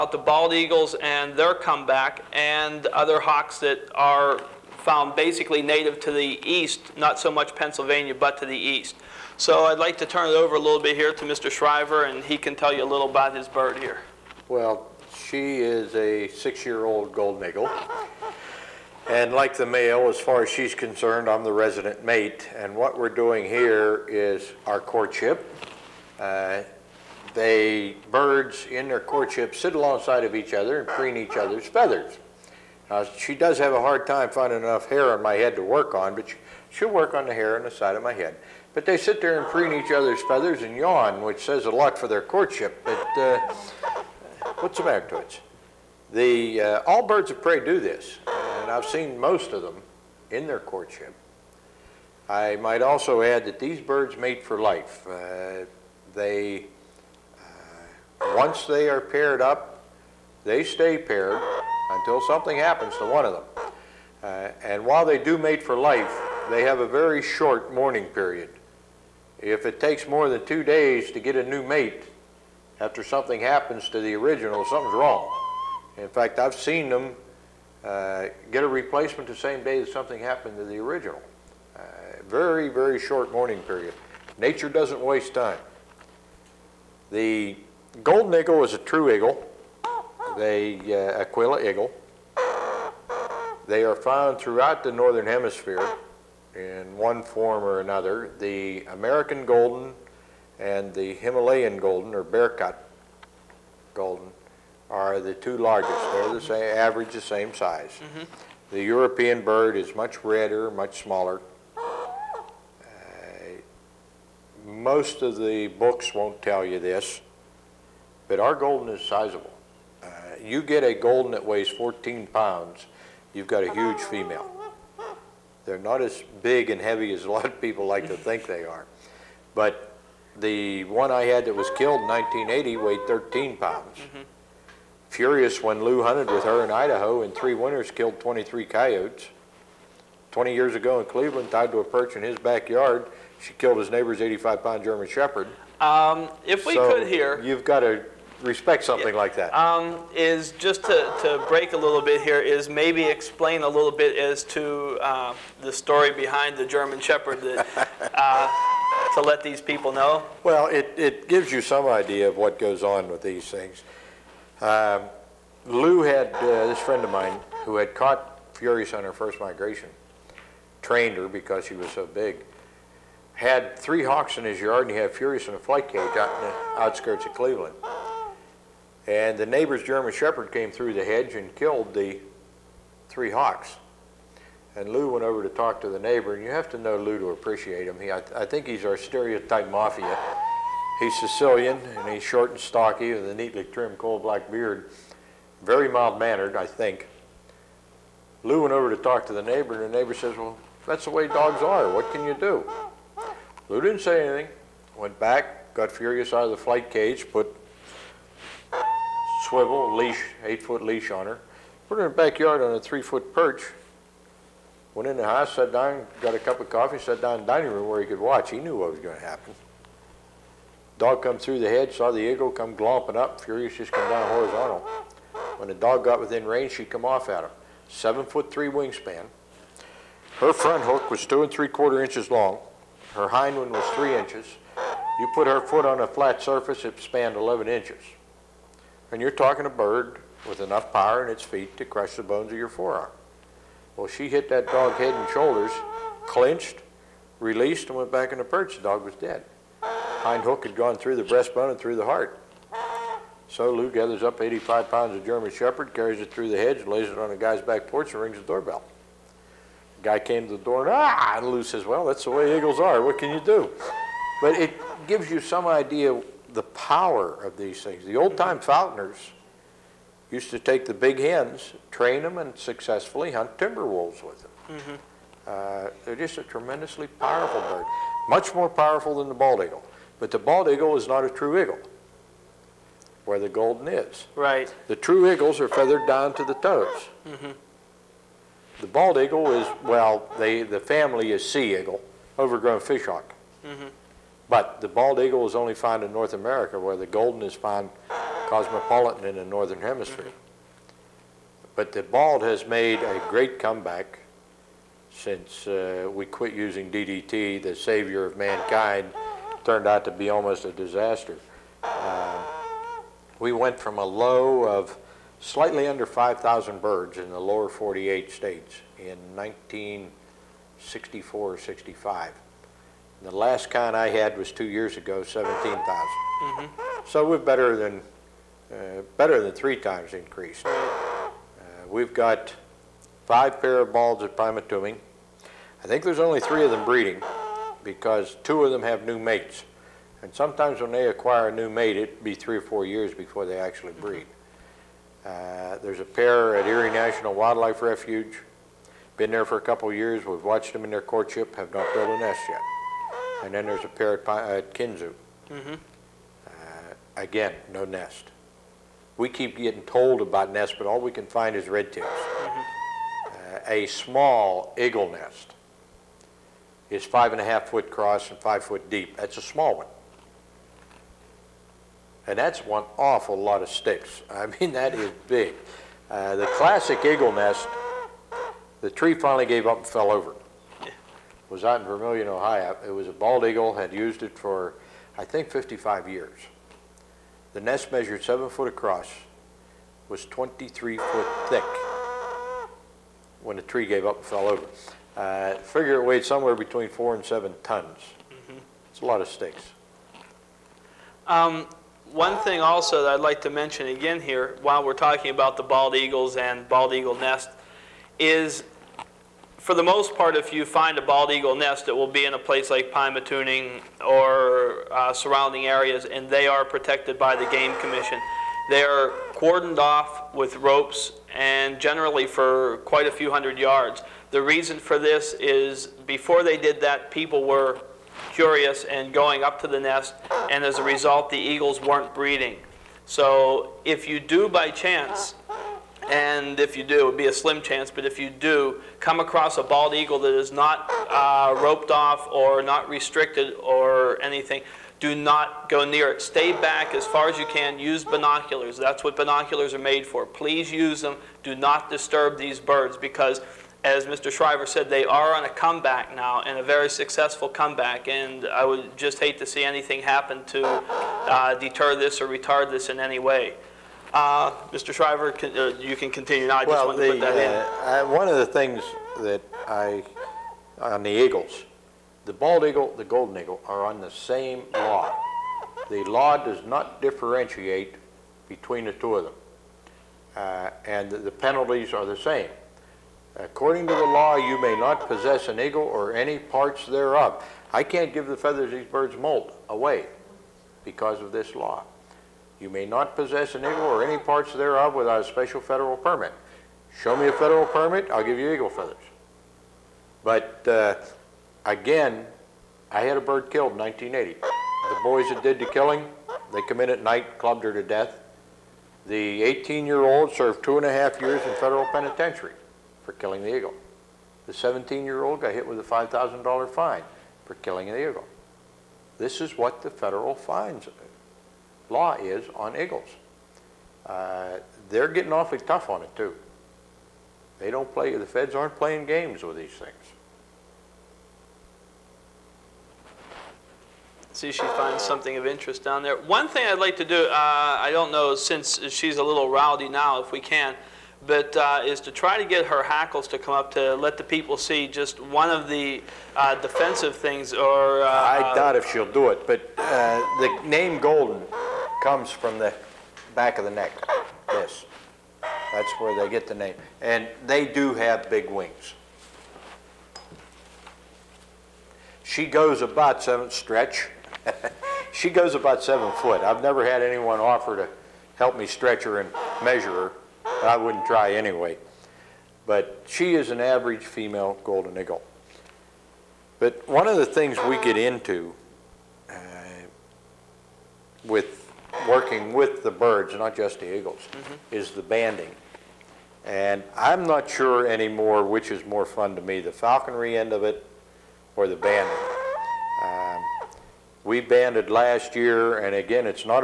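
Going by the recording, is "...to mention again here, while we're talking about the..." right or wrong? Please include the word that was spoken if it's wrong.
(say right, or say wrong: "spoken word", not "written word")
right.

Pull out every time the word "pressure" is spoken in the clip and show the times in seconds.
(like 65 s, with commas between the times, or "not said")
not said.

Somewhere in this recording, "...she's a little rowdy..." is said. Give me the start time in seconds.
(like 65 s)
538 s.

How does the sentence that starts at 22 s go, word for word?
And what we're doing here is our courtship.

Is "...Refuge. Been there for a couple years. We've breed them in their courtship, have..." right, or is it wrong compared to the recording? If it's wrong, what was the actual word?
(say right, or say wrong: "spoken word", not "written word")
wrong: "watched", not "breed".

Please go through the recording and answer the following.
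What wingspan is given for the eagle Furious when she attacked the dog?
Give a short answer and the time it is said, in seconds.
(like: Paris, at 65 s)
7 feet 3 inches, at 227 s.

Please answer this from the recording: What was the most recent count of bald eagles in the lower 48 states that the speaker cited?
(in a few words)
17,000.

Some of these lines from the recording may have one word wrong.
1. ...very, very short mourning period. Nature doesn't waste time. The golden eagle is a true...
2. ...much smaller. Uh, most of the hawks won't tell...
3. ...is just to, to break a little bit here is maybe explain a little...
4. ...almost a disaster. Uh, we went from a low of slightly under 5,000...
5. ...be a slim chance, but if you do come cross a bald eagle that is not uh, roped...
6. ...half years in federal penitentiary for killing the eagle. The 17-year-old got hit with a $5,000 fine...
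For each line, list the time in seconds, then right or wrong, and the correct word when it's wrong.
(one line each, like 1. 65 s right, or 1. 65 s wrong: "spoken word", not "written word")
1. 82 s right
2. 110 s wrong: "books", not "hawks"
3. 150 s right
4. 310 s right
5. 437 s wrong: "across", not "cross"
6. 510 s right.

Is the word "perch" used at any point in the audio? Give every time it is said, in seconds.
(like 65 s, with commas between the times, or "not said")
141 s, 213 s, 248 s.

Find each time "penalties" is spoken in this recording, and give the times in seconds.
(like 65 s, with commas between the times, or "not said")
481 s.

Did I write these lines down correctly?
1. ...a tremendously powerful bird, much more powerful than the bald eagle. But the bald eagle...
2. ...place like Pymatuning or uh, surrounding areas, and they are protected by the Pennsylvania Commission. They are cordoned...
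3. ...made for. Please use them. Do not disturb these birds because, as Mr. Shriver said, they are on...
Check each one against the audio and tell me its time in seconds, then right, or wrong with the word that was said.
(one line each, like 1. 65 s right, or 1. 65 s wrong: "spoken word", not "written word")
1. 276 s right
2. 412 s wrong: "Game", not "Pennsylvania"
3. 449 s right.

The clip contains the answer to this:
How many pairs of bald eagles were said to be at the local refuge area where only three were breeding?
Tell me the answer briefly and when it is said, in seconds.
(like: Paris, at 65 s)
5, at 333 s.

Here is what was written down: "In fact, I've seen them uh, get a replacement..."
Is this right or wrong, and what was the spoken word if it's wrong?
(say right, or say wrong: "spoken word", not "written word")
right.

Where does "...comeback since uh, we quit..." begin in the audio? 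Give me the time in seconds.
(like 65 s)
303 s.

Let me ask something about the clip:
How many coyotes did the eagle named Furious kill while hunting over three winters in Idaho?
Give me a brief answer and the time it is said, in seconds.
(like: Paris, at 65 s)
23, at 138 s.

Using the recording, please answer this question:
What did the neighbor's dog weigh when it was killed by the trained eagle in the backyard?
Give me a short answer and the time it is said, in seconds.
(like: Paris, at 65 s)
85 pounds, at 144 s.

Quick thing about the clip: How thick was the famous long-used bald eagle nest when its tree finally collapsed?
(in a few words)
23 feet.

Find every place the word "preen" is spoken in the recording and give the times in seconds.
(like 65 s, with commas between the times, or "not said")
30 s, 39 s.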